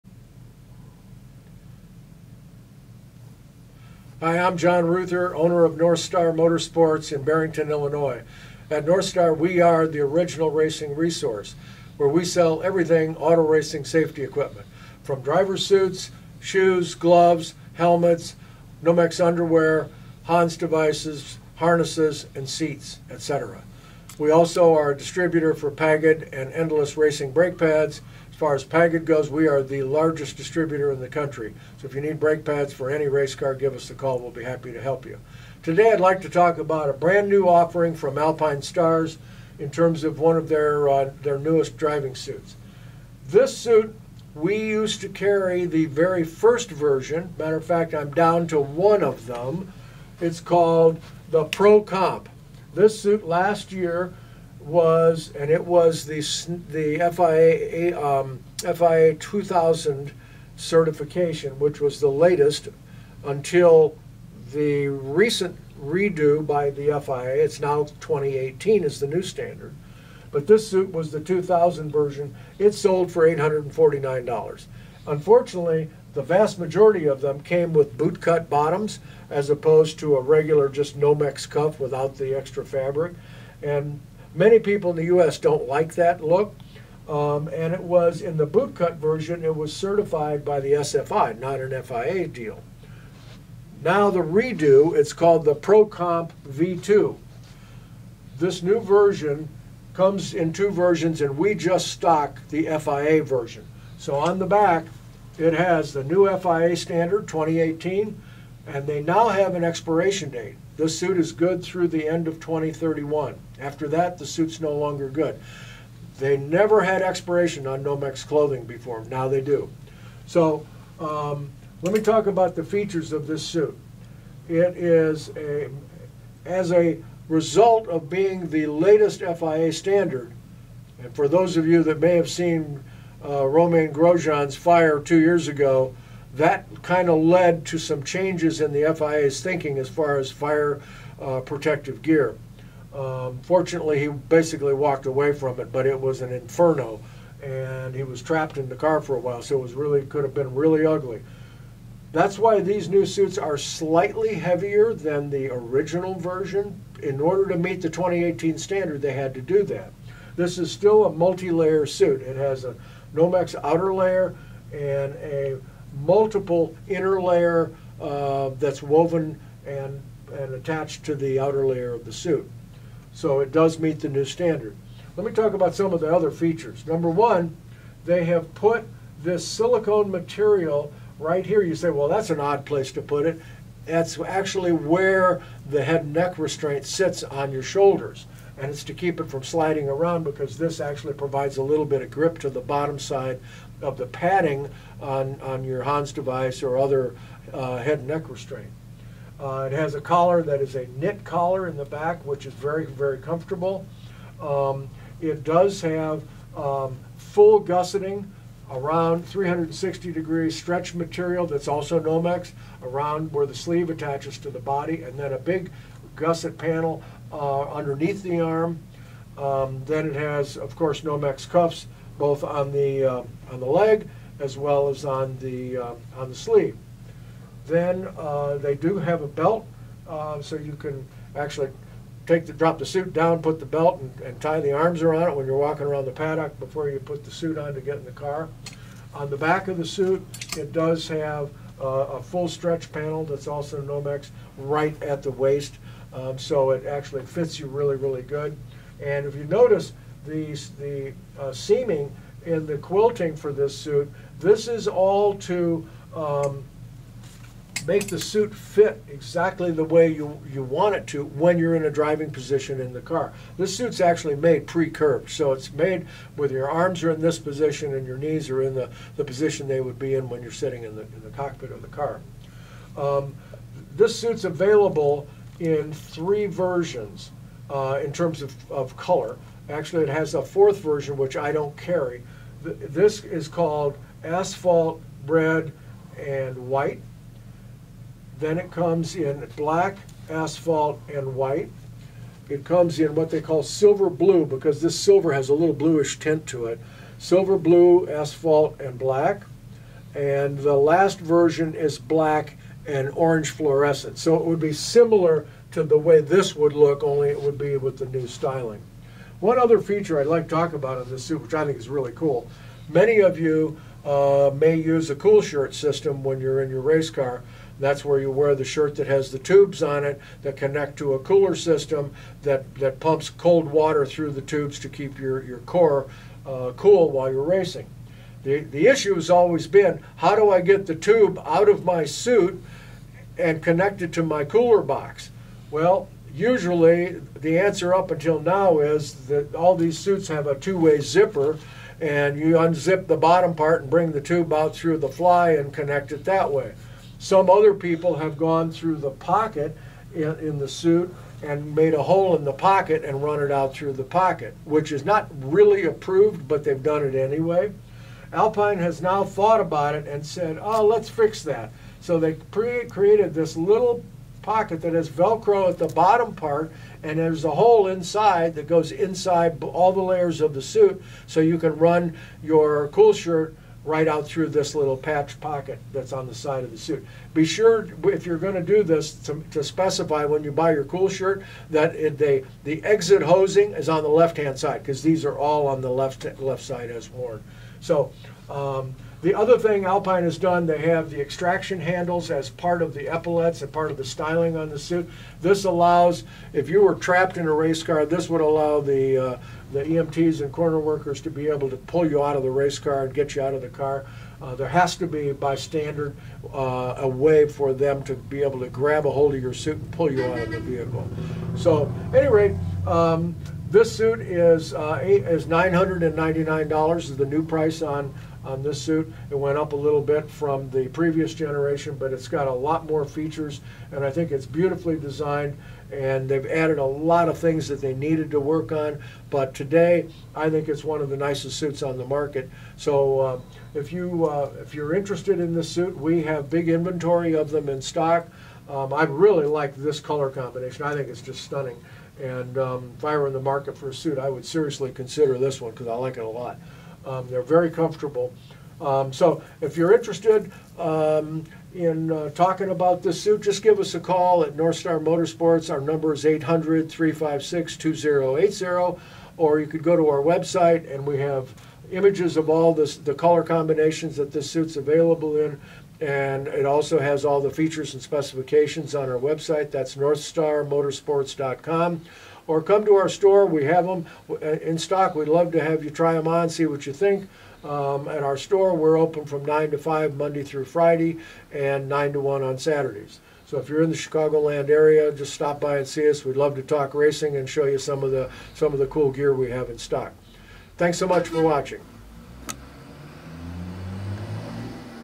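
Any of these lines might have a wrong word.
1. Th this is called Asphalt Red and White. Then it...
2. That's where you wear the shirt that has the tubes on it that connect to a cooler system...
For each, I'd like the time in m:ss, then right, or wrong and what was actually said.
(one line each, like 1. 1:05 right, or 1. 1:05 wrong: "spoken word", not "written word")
1. 4:42 right
2. 5:17 right.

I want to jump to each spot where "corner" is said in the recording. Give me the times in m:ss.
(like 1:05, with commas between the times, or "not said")
6:40.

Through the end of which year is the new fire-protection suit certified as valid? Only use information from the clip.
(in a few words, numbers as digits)
2031.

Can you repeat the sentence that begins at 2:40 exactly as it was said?
This is still a multi-layer suit.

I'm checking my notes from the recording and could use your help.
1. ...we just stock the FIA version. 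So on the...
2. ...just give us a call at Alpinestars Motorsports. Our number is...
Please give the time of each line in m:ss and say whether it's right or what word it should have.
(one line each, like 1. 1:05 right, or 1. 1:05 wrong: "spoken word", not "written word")
1. 1:41 right
2. 7:33 wrong: "Northstar", not "Alpinestars".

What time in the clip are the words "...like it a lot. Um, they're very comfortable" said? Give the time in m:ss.
7:25.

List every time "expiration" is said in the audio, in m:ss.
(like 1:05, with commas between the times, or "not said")
1:49, 1:57.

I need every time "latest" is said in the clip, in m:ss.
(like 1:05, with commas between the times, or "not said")
1:02, 2:08.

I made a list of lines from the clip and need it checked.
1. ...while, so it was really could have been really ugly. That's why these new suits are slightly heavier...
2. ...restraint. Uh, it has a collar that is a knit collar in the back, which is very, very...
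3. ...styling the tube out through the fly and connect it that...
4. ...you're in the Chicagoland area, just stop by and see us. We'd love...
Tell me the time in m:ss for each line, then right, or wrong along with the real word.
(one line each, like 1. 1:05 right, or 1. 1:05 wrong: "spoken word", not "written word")
1. 2:29 right
2. 3:18 right
3. 5:43 wrong: "bring", not "styling"
4. 8:03 right.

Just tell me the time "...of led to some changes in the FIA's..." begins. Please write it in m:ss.
2:17.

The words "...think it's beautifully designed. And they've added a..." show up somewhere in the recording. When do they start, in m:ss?
7:04.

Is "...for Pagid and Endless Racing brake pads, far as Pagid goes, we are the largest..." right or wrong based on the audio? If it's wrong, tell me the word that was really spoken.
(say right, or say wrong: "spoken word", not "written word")
right.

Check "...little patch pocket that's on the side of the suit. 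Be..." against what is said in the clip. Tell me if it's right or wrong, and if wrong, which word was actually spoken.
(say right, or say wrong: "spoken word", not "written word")
right.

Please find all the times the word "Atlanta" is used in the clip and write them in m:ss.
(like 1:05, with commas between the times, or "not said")
not said.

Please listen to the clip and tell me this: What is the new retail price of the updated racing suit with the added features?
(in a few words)
$999.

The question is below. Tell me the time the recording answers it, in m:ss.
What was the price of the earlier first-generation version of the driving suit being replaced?
1:13.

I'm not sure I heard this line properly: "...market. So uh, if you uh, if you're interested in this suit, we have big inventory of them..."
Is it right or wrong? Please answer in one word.
right.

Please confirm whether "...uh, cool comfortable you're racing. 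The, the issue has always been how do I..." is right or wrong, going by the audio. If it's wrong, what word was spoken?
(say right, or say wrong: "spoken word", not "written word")
wrong: "while", not "comfortable".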